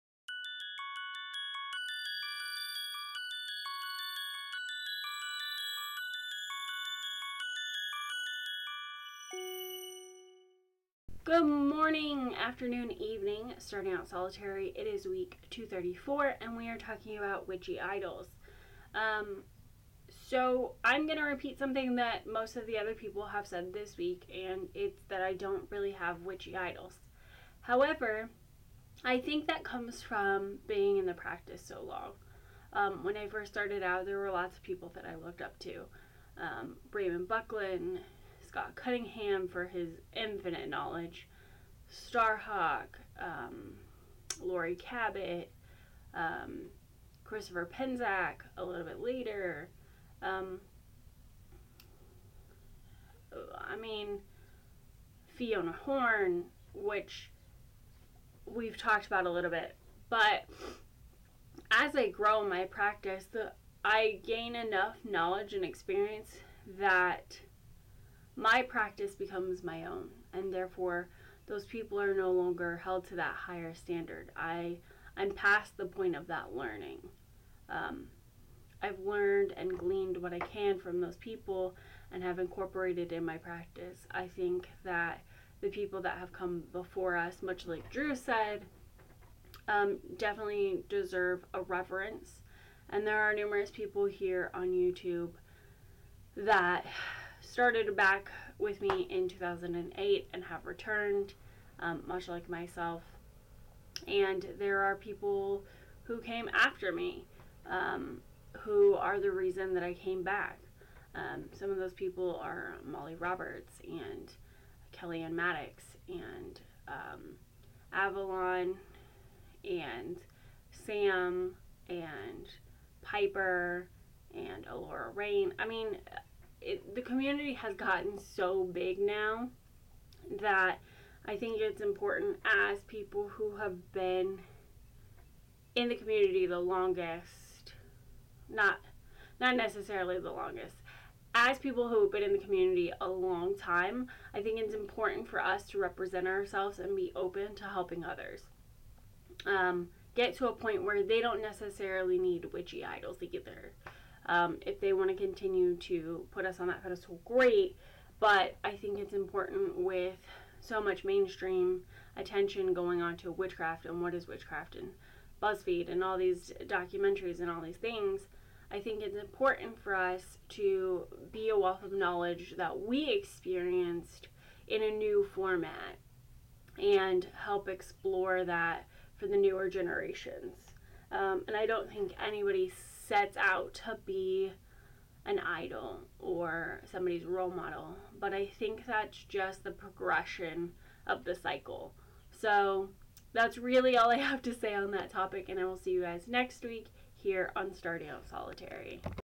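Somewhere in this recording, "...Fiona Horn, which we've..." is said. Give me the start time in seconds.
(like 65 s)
55 s.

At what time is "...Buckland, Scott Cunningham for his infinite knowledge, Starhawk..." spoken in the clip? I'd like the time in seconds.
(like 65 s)
37 s.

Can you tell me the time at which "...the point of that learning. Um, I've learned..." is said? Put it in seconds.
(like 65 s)
75 s.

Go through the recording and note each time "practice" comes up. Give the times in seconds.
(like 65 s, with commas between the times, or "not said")
31 s, 62 s, 68 s, 83 s.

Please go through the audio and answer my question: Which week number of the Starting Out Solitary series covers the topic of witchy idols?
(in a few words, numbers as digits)
234.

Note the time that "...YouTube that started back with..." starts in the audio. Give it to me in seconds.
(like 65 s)
94 s.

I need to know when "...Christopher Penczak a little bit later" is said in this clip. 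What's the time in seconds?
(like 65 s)
47 s.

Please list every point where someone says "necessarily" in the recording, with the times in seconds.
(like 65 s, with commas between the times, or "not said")
139 s, 151 s.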